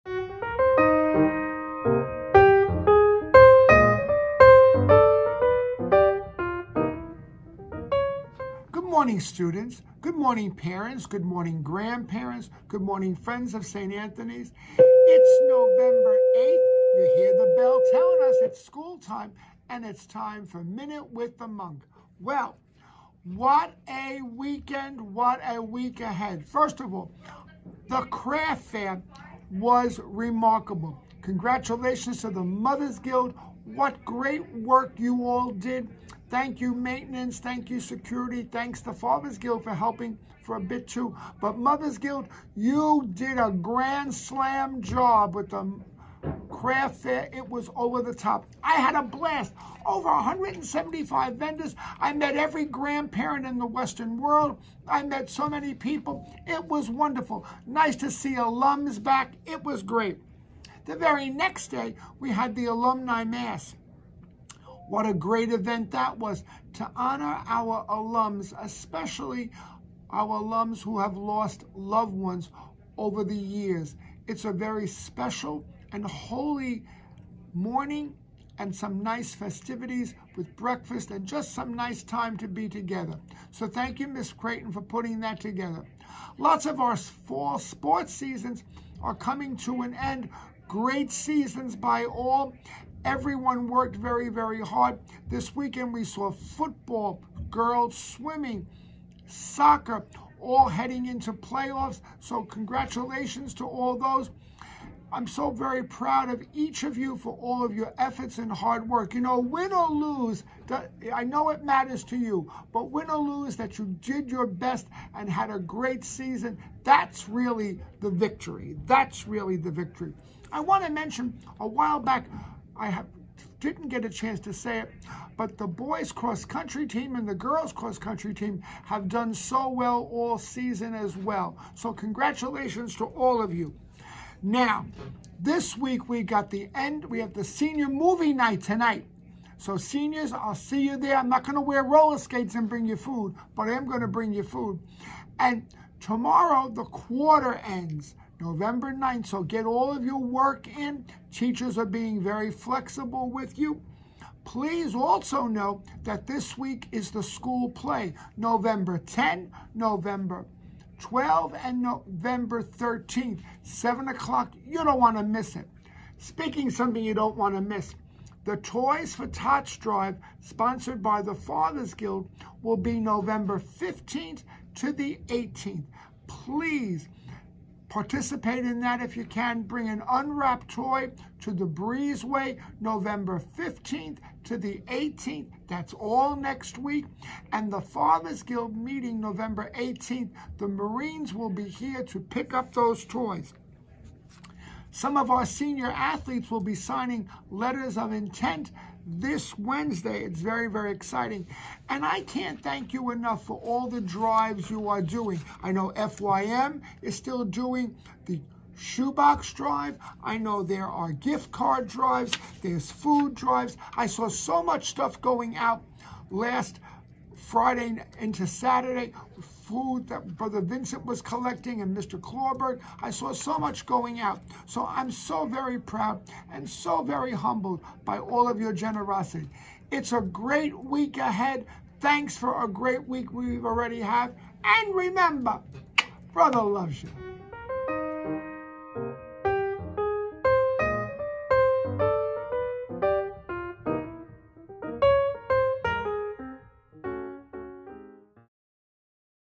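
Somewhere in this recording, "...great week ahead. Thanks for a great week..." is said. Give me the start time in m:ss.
3:50.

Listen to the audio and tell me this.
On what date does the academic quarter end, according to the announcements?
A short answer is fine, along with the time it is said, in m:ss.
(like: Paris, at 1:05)
November 9th, at 2:28.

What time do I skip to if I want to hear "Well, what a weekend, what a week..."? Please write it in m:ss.
0:22.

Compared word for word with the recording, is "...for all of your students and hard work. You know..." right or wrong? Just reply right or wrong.
wrong.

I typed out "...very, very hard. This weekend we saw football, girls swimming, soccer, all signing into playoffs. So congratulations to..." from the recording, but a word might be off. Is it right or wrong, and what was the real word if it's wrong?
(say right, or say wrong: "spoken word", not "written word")
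wrong: "heading", not "signing".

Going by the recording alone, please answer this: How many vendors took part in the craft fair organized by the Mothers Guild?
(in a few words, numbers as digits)
Over 175.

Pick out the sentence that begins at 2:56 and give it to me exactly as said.
Please Participate in that if you can.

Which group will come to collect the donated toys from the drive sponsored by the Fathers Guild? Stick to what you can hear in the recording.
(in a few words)
The Marines.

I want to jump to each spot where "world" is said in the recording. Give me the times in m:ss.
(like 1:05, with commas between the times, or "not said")
0:54.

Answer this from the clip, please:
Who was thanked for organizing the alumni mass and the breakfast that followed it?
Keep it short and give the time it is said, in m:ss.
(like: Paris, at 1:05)
Miss Creighton, at 1:24.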